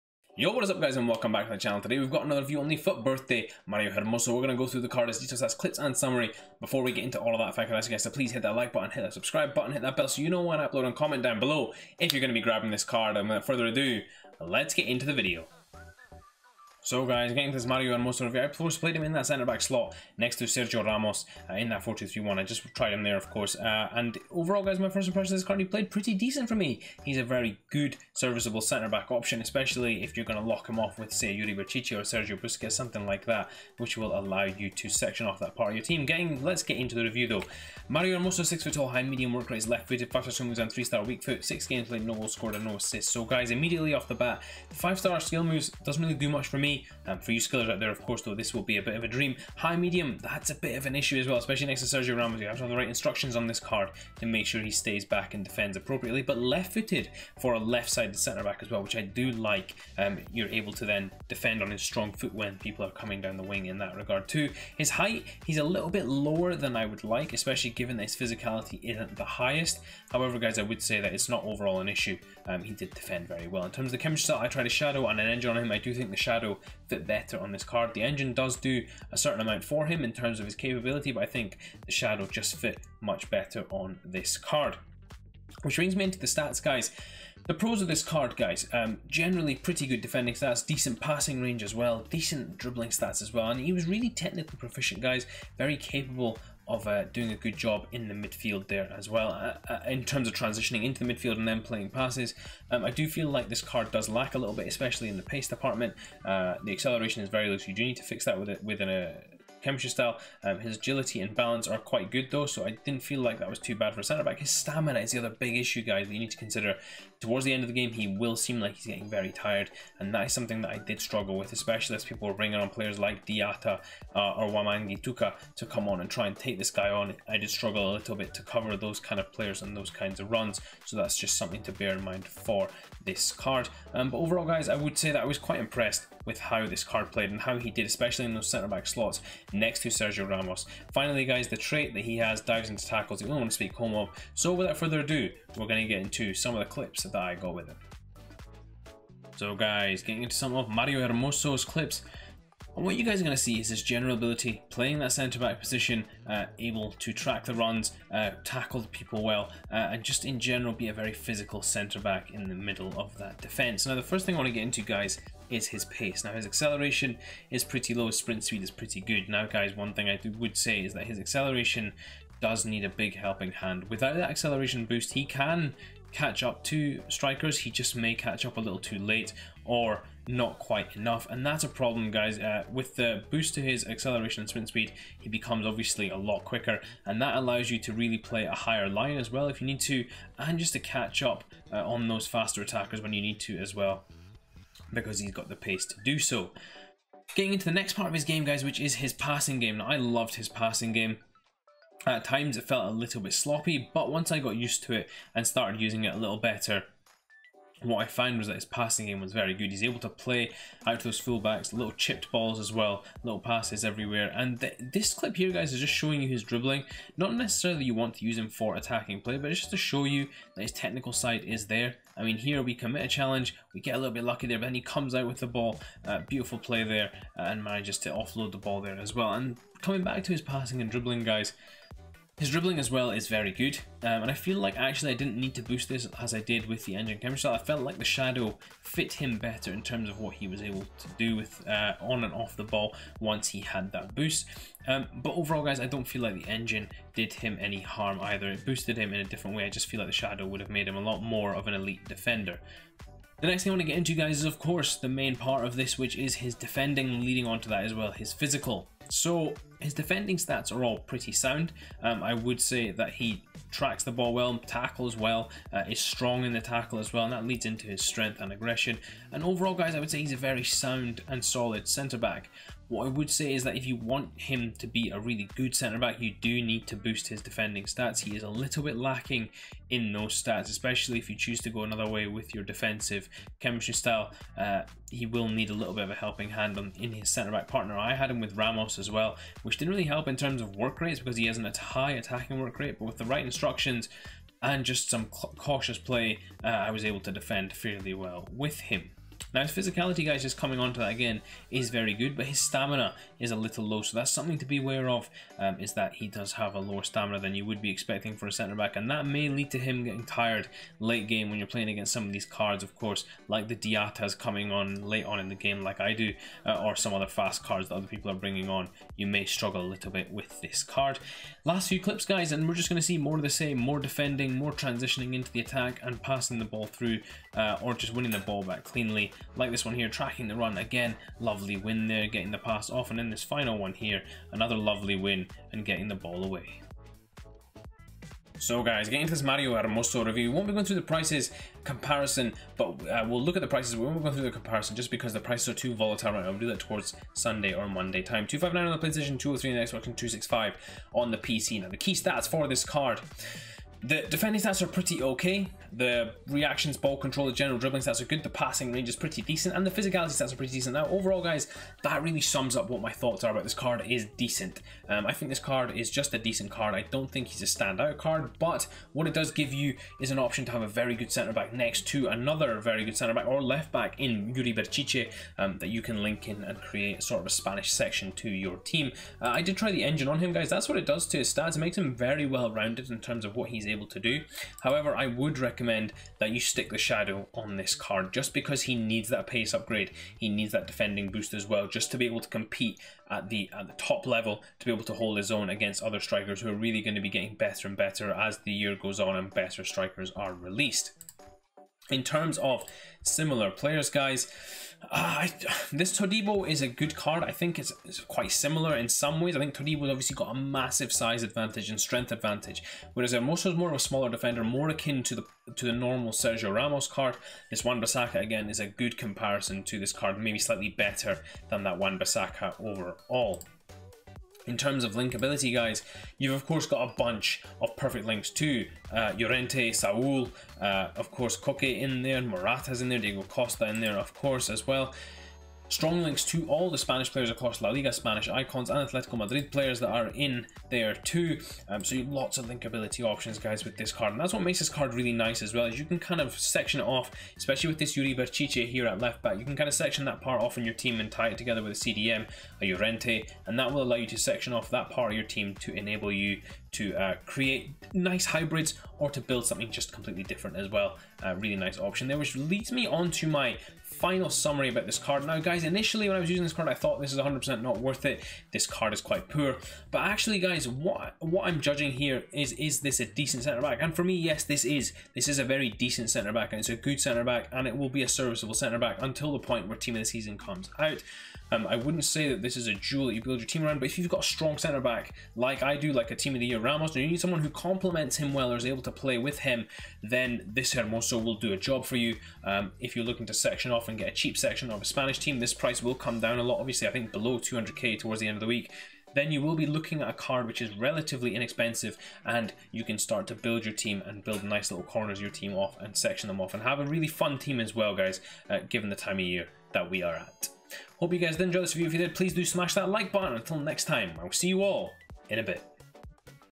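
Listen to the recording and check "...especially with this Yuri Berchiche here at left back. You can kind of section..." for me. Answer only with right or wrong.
right.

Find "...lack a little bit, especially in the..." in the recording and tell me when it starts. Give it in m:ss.
1:44.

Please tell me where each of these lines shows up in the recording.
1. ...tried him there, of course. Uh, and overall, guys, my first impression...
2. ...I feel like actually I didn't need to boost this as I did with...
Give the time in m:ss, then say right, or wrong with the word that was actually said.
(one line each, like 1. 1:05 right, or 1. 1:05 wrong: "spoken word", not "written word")
1. 0:22 right
2. 3:54 right.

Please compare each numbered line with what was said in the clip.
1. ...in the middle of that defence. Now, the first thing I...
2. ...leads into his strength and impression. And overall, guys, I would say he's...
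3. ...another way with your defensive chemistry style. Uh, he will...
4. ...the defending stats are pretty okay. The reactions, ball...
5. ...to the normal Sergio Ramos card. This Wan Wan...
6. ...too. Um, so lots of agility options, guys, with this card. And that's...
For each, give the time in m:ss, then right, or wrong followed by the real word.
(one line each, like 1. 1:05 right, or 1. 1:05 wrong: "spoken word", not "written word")
1. 2:42 right
2. 4:27 wrong: "aggression", not "impression"
3. 4:41 right
4. 5:54 right
5. 6:55 wrong: "Bissaka", not "Wan"
6. 7:21 wrong: "linkability", not "agility".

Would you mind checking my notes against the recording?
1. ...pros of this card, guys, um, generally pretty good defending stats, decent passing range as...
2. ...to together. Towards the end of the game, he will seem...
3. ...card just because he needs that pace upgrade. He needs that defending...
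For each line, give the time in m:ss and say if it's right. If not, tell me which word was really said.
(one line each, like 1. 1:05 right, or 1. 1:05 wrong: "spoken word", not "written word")
1. 1:27 right
2. 1:56 wrong: "consider", not "together"
3. 6:27 right.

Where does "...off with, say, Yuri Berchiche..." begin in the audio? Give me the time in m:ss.
0:30.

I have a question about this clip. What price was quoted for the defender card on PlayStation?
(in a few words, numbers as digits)
259.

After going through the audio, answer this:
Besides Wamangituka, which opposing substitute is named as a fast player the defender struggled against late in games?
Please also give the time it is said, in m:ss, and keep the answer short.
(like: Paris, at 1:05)
Diatta, at 2:03.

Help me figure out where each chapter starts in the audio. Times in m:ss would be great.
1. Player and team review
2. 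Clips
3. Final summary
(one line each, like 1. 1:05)
1. 0:17
2. 2:30
3. 5:40.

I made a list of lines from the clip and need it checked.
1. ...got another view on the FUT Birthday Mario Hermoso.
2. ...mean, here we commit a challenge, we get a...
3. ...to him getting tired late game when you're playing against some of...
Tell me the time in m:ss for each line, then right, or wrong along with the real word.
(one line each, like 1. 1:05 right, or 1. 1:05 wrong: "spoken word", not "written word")
1. 0:02 right
2. 3:42 right
3. 5:09 right.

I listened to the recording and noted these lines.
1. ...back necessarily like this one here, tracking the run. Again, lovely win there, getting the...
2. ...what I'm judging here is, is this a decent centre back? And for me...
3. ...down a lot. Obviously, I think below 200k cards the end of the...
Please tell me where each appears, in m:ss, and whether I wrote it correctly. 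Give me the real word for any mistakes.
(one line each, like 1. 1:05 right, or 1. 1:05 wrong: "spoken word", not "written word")
1. 5:28 wrong: "cleanly", not "necessarily"
2. 7:51 right
3. 8:16 wrong: "towards", not "cards".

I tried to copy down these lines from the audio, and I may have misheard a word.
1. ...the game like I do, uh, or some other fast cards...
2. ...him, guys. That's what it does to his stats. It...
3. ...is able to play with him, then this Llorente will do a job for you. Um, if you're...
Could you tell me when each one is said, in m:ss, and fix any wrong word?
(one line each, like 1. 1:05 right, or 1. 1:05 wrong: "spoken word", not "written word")
1. 5:15 right
2. 6:20 right
3. 8:08 wrong: "Hermoso", not "Llorente".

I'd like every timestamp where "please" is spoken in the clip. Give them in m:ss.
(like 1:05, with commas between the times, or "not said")
0:08, 8:32.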